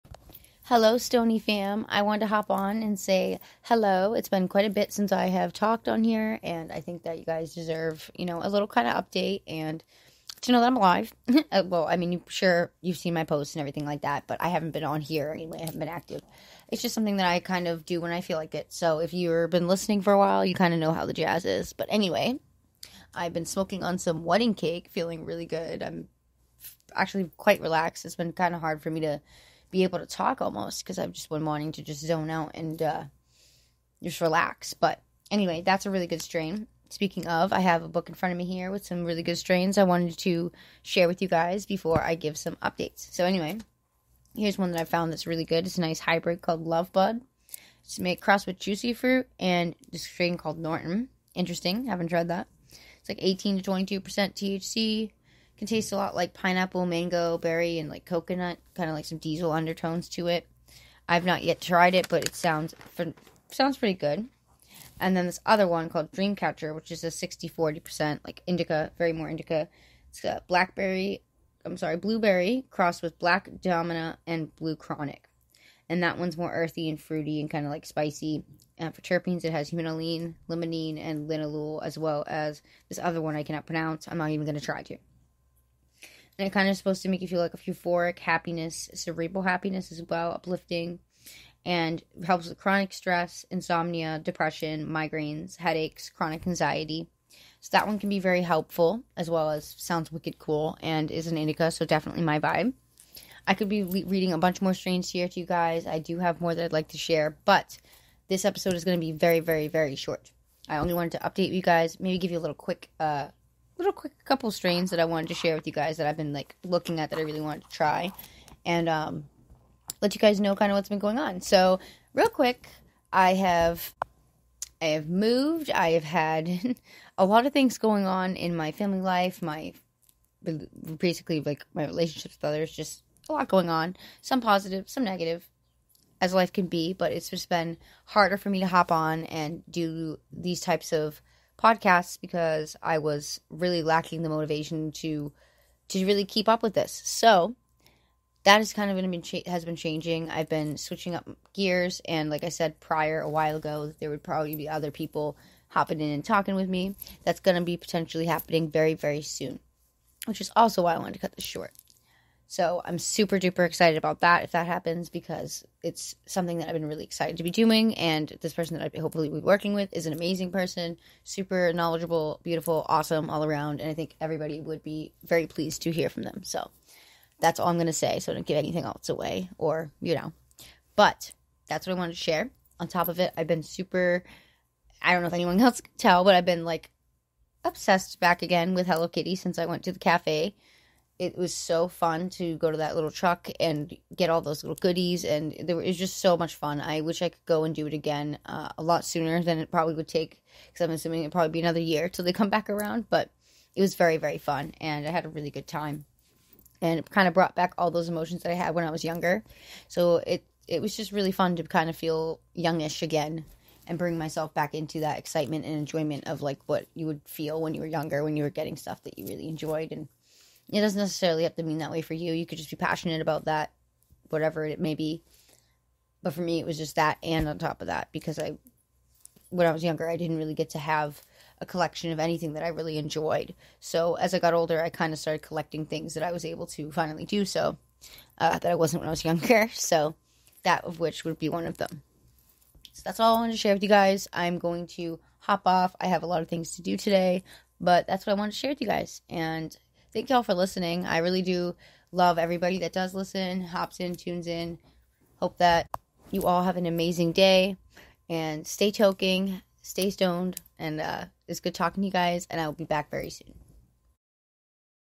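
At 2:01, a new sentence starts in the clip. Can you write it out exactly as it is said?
So, real quick, I have I have moved.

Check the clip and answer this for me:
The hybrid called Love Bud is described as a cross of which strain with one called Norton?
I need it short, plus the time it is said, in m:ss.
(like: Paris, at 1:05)
Juicy Fruit, at 0:48.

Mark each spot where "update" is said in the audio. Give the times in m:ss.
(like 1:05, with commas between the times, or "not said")
0:08, 0:42, 1:51.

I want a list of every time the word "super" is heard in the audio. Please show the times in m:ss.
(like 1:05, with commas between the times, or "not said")
2:42, 2:51, 3:03.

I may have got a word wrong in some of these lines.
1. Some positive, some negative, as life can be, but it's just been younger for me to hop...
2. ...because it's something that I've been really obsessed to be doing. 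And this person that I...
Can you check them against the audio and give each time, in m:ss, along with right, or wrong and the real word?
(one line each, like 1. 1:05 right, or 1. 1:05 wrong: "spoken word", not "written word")
1. 2:14 wrong: "harder", not "younger"
2. 2:45 wrong: "excited", not "obsessed".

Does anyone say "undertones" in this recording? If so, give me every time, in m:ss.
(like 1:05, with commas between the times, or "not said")
0:59.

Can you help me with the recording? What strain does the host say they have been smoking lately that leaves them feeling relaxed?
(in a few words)
Wedding Cake.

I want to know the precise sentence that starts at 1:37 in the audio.
So that one can be very helpful as well as sounds wicked cool and is an indica, so definitely my vibe.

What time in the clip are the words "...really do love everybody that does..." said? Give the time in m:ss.
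4:11.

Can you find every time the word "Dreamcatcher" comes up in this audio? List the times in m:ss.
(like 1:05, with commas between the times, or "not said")
1:06.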